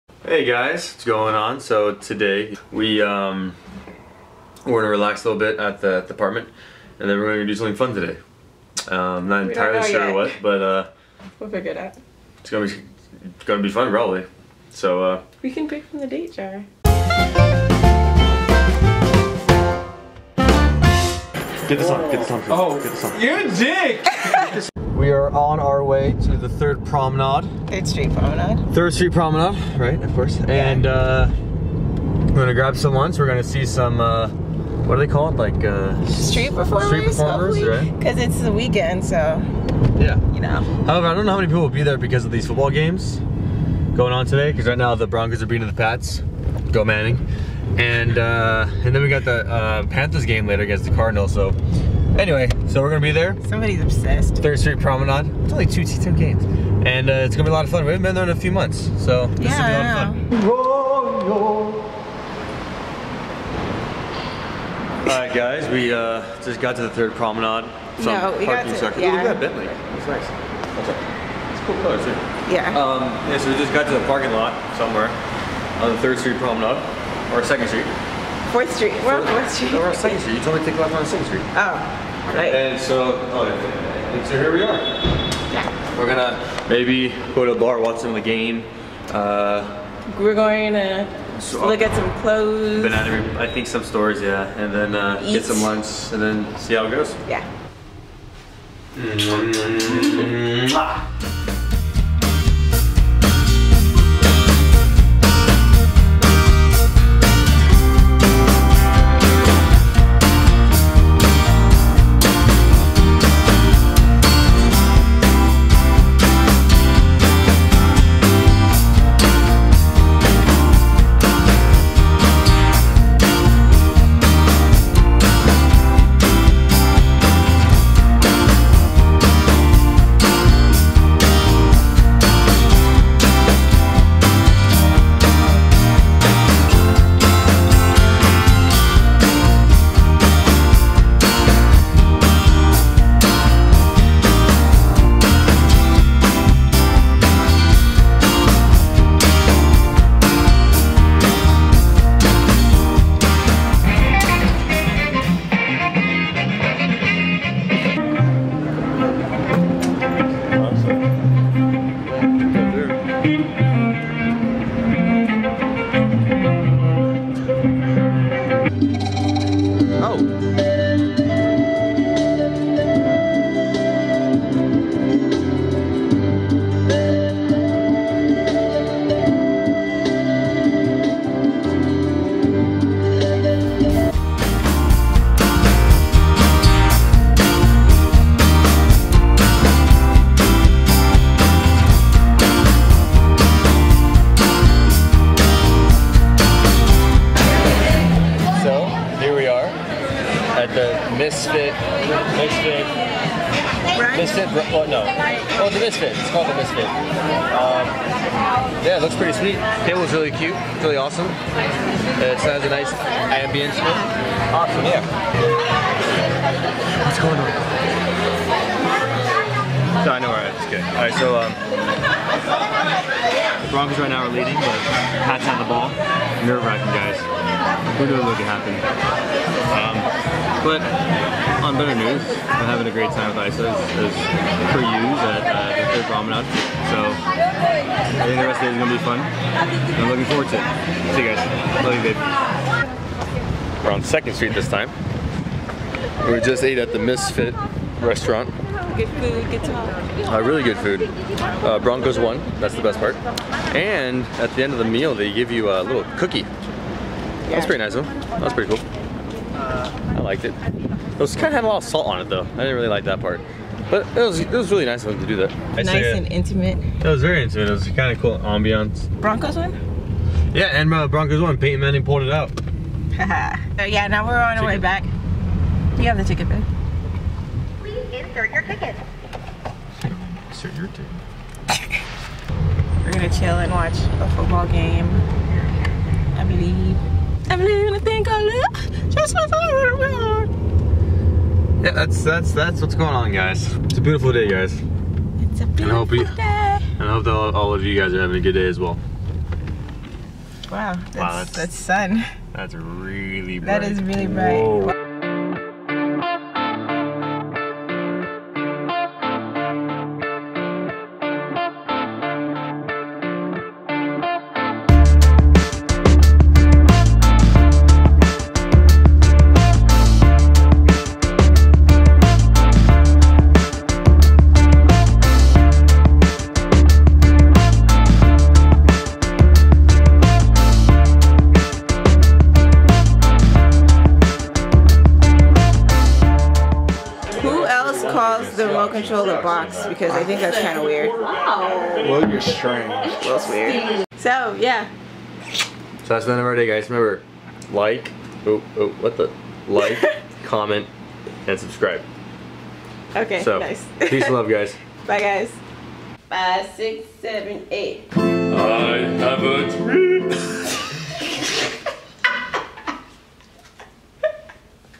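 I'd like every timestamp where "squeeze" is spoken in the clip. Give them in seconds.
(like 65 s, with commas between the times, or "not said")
not said.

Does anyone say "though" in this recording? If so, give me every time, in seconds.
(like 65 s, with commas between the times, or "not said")
257 s, 262 s.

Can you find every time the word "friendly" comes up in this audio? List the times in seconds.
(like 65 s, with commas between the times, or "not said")
not said.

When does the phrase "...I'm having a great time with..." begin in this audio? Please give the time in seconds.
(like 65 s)
232 s.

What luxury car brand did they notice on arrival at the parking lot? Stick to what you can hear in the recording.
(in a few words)
Bentley.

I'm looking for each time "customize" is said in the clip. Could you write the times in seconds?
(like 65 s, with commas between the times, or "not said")
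not said.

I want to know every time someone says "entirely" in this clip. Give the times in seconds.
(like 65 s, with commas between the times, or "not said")
9 s.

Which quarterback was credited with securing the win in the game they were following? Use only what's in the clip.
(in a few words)
Peyton Manning.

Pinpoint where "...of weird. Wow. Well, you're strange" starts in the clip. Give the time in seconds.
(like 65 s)
340 s.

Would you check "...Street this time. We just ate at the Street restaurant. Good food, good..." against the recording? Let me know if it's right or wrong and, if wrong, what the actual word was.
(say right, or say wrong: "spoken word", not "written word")
wrong: "Misfit", not "Street".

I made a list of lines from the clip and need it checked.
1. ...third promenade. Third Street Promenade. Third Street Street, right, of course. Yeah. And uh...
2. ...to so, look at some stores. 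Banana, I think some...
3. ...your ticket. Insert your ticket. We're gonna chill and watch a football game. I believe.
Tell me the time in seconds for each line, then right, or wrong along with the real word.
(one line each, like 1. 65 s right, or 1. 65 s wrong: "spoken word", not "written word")
1. 26 s wrong: "Promenade", not "Street"
2. 90 s wrong: "clothes", not "stores"
3. 278 s right.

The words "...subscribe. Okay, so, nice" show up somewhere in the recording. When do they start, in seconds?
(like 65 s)
351 s.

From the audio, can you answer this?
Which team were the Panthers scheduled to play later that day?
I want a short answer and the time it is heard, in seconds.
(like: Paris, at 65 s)
Cardinals, at 50 s.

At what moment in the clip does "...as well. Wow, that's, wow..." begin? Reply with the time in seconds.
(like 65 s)
298 s.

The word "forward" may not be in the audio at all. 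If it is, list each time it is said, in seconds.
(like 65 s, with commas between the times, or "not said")
240 s.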